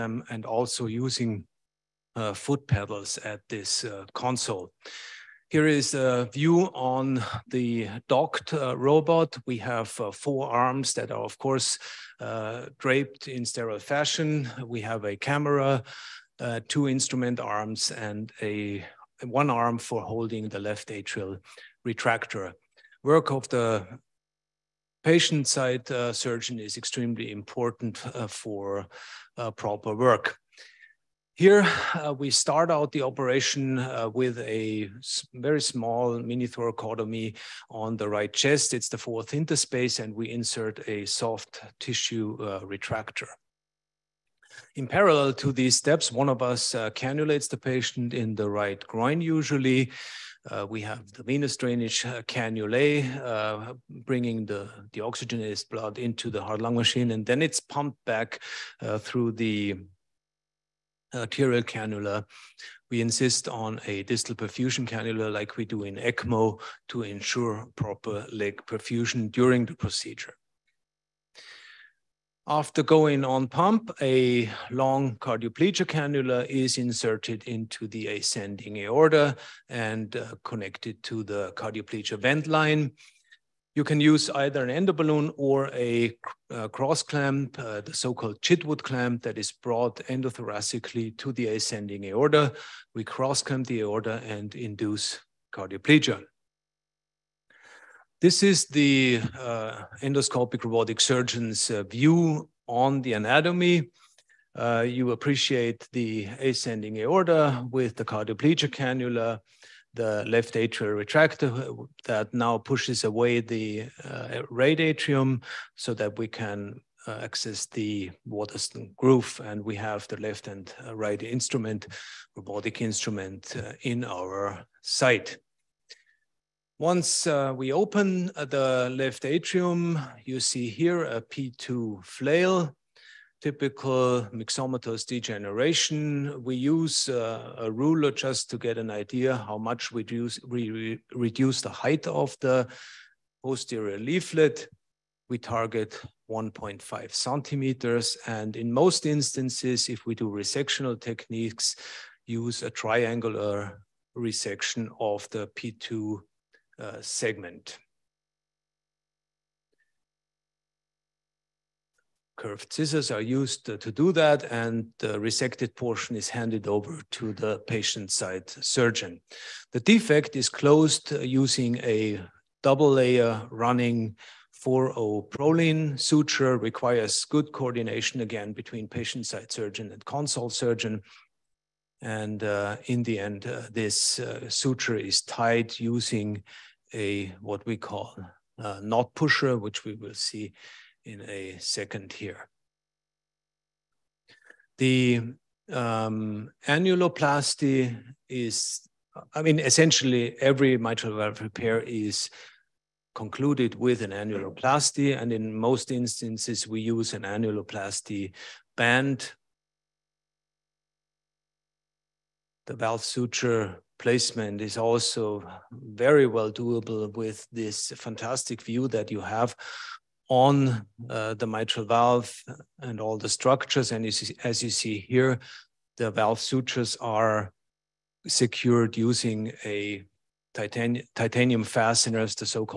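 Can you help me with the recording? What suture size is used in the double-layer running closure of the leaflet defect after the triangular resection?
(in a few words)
4-0 Prolene.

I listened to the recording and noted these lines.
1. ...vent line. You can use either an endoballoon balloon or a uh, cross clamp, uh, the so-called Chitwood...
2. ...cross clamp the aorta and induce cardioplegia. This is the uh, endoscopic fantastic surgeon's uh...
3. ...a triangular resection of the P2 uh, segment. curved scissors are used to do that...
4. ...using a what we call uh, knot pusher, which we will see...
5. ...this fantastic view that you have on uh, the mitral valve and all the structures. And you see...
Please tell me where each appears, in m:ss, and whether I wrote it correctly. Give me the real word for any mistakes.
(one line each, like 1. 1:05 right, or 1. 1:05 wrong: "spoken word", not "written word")
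1. 1:22 right
2. 1:33 wrong: "robotic", not "fantastic"
3. 2:32 right
4. 3:05 right
5. 3:37 right.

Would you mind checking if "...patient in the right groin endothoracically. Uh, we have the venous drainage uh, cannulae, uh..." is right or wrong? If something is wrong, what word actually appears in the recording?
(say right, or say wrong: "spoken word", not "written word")
wrong: "usually", not "endothoracically".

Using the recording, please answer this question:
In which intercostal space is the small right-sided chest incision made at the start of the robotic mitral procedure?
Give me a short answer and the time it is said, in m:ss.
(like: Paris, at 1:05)
Fourth interspace, at 0:38.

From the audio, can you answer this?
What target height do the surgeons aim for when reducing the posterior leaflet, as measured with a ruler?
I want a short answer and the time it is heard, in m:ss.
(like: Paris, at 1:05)
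1.5 centimeters, at 2:26.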